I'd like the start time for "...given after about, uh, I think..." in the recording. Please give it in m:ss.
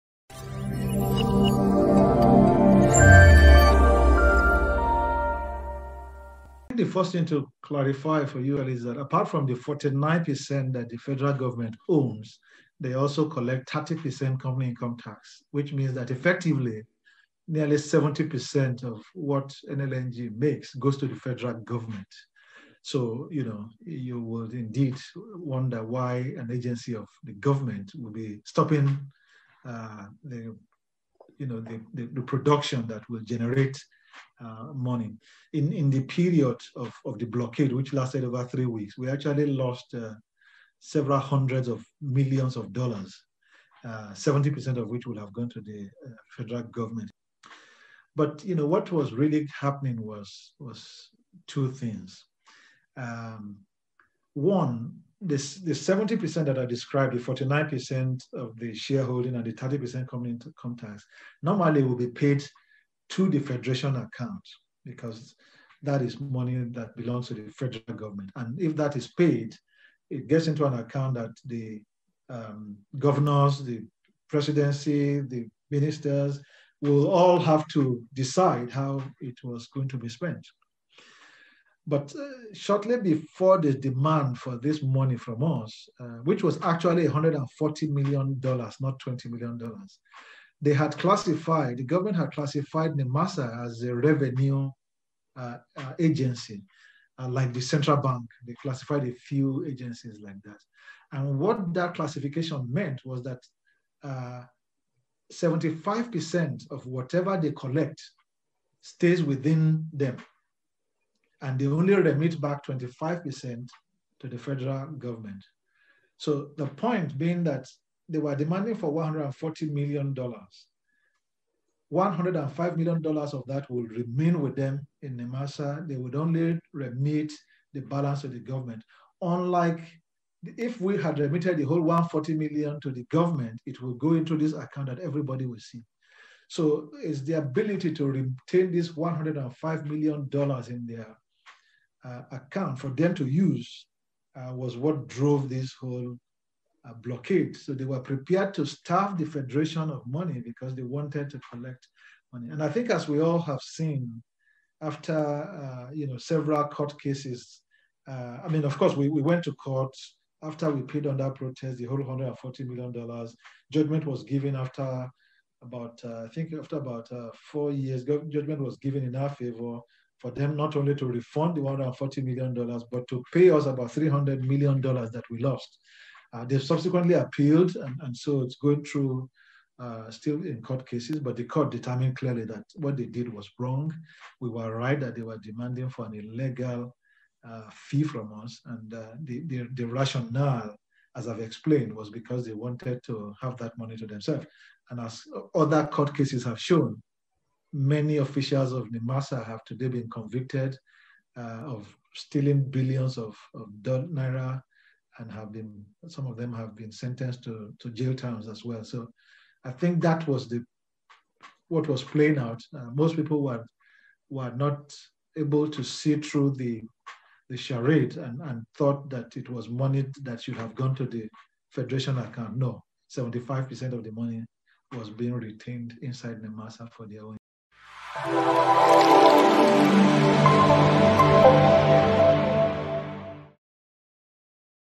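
2:44.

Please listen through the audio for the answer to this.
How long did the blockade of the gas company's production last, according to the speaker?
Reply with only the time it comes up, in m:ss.
0:38.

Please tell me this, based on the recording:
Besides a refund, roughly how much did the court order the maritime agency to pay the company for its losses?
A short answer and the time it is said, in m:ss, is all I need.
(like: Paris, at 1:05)
$300 million, at 2:53.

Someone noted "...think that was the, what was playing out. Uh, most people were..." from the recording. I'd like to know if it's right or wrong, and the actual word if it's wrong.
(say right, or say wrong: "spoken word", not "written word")
right.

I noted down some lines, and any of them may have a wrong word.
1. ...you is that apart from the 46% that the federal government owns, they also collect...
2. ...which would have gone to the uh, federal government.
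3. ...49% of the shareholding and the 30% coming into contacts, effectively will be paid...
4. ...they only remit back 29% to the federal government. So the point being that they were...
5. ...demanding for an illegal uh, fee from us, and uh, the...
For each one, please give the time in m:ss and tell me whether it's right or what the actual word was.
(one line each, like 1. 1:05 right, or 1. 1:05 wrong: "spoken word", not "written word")
1. 0:08 wrong: "49", not "46"
2. 0:44 right
3. 0:57 wrong: "normally", not "effectively"
4. 1:51 wrong: "25", not "29"
5. 3:05 right.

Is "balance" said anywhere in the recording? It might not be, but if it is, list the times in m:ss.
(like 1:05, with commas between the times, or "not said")
2:07.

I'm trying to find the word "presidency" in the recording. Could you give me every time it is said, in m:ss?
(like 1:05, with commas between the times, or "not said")
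1:14.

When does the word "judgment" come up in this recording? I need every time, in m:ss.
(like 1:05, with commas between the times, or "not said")
2:43, 2:48.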